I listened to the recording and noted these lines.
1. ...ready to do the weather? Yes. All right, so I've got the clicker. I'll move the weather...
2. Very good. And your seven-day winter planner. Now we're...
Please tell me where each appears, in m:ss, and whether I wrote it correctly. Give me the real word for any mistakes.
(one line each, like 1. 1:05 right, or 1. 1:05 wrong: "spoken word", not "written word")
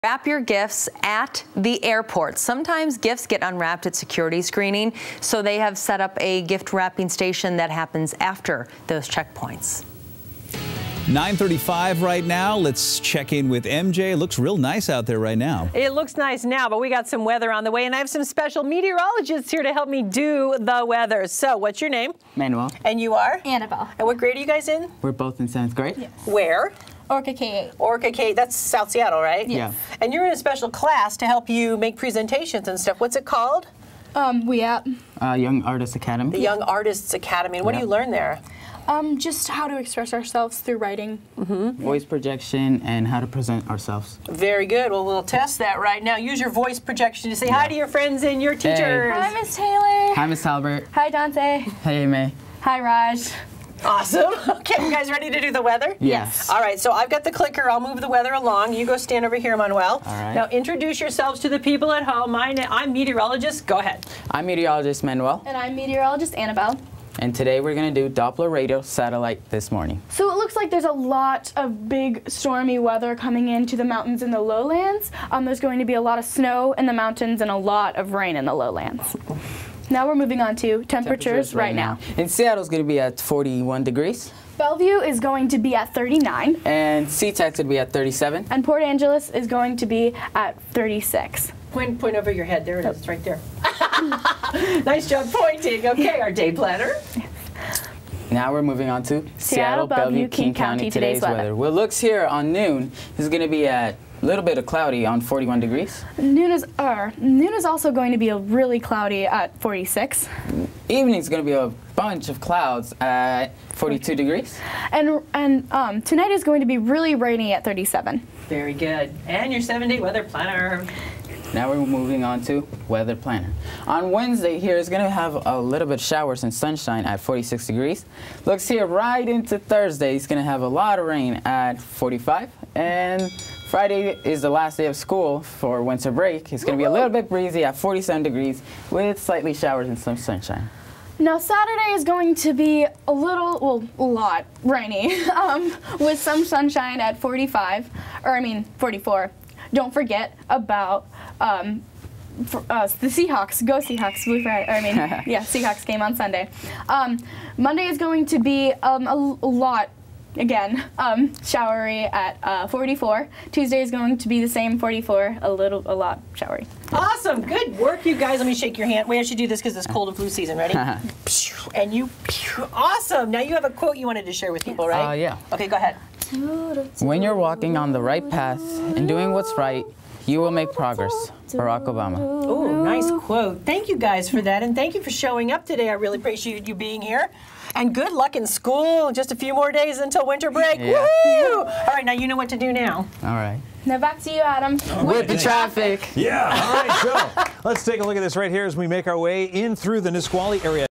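1. 0:55 right
2. 1:58 wrong: "weather", not "winter".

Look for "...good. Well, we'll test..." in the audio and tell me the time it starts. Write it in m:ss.
0:44.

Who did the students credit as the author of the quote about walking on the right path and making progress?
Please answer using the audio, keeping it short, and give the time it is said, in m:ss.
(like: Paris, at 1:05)
Barack Obama, at 3:01.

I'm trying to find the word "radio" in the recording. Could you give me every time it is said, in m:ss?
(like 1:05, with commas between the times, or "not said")
1:08.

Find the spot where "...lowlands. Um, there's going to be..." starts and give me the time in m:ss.
1:14.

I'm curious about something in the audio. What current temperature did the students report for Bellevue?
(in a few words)
39 degrees.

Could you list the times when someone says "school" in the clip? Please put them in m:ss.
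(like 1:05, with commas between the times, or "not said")
2:14, 3:08.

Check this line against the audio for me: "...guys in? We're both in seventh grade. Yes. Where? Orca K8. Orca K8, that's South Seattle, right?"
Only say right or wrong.
right.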